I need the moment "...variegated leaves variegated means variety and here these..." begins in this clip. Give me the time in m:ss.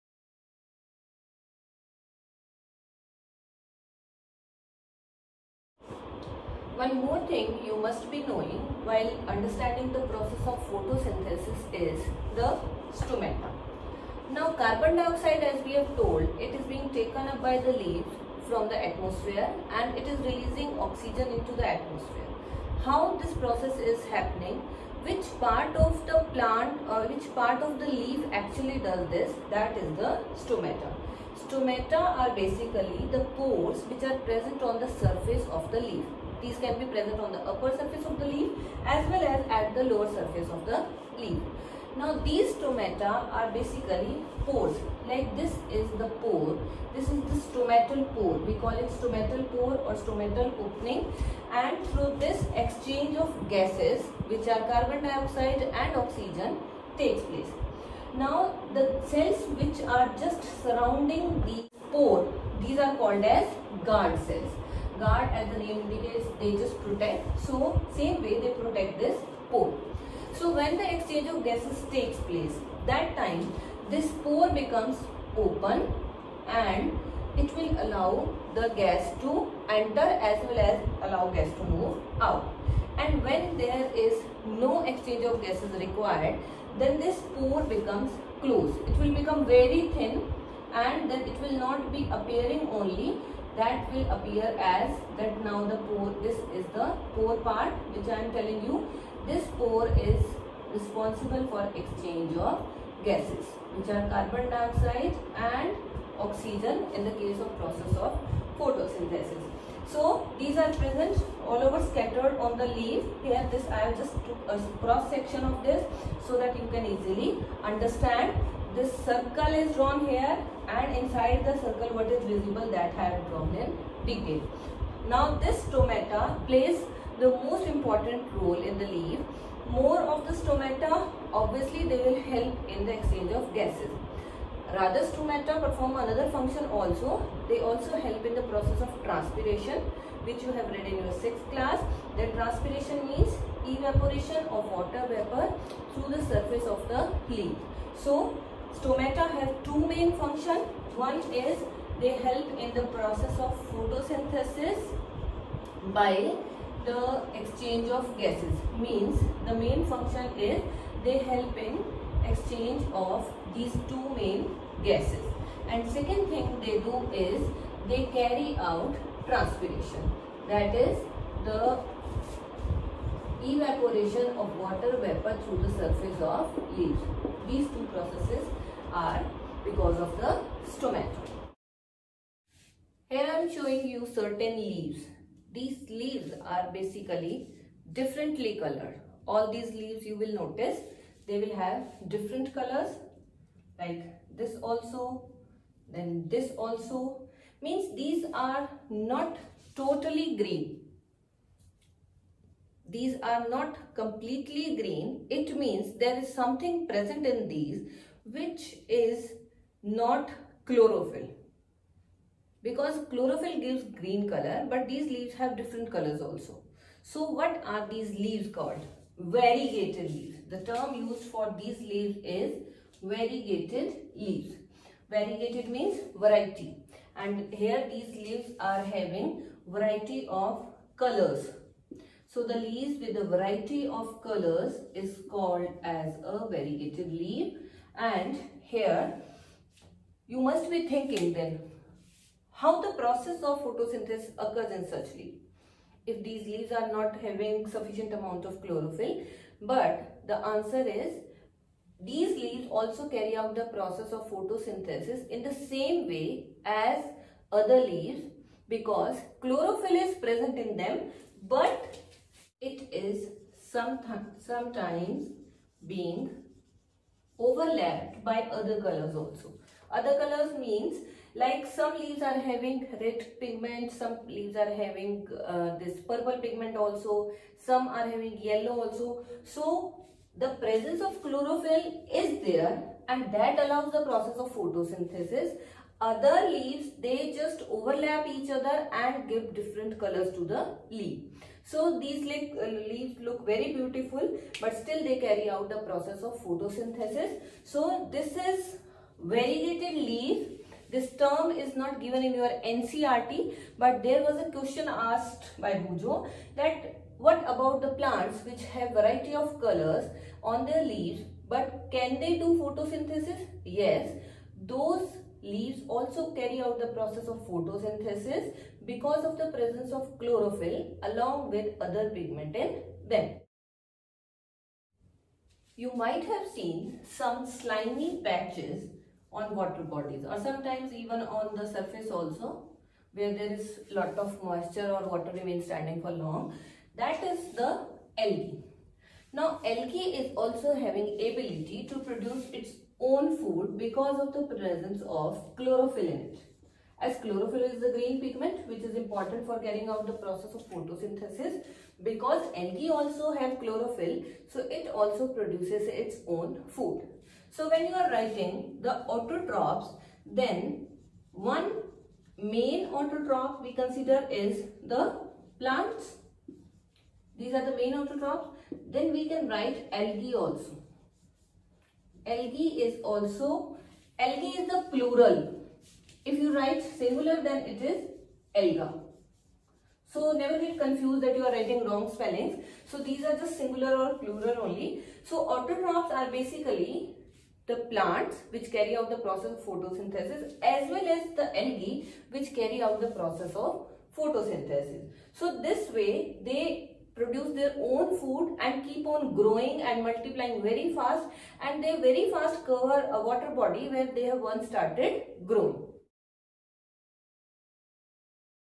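3:43.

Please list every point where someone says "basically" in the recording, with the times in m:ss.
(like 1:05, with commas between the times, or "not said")
0:32, 0:43, 3:06, 6:26.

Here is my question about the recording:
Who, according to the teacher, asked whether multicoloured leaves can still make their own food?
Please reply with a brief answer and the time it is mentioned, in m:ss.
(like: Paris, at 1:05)
Bujo, at 5:05.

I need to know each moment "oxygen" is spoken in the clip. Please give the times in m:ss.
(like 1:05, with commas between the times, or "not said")
0:20, 0:55, 1:46.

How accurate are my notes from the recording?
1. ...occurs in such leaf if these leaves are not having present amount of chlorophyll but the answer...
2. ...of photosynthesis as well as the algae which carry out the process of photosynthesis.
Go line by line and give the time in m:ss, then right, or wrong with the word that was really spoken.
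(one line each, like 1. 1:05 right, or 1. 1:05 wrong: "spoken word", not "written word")
1. 4:04 wrong: "sufficient", not "present"
2. 6:29 right.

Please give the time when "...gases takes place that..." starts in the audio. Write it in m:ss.
1:11.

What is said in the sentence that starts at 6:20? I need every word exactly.
So never get confused that you are writing wrong spellings.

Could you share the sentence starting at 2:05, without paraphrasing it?
Now this stomata plays the most important role in the leaf.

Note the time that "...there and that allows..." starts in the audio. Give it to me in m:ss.
4:42.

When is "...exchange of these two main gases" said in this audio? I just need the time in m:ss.
2:42.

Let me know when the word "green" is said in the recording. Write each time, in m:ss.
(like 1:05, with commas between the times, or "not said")
3:20, 3:24, 3:33, 5:47.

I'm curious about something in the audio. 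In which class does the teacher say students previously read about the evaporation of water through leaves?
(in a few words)
6th class.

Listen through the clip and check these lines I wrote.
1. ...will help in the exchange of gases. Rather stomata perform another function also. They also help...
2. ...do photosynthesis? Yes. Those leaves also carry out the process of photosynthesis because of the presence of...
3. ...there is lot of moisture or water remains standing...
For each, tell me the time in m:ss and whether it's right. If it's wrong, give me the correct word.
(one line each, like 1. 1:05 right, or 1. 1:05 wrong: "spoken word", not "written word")
1. 2:11 right
2. 5:12 right
3. 5:33 right.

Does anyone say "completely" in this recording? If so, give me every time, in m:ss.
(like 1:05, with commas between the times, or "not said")
3:23.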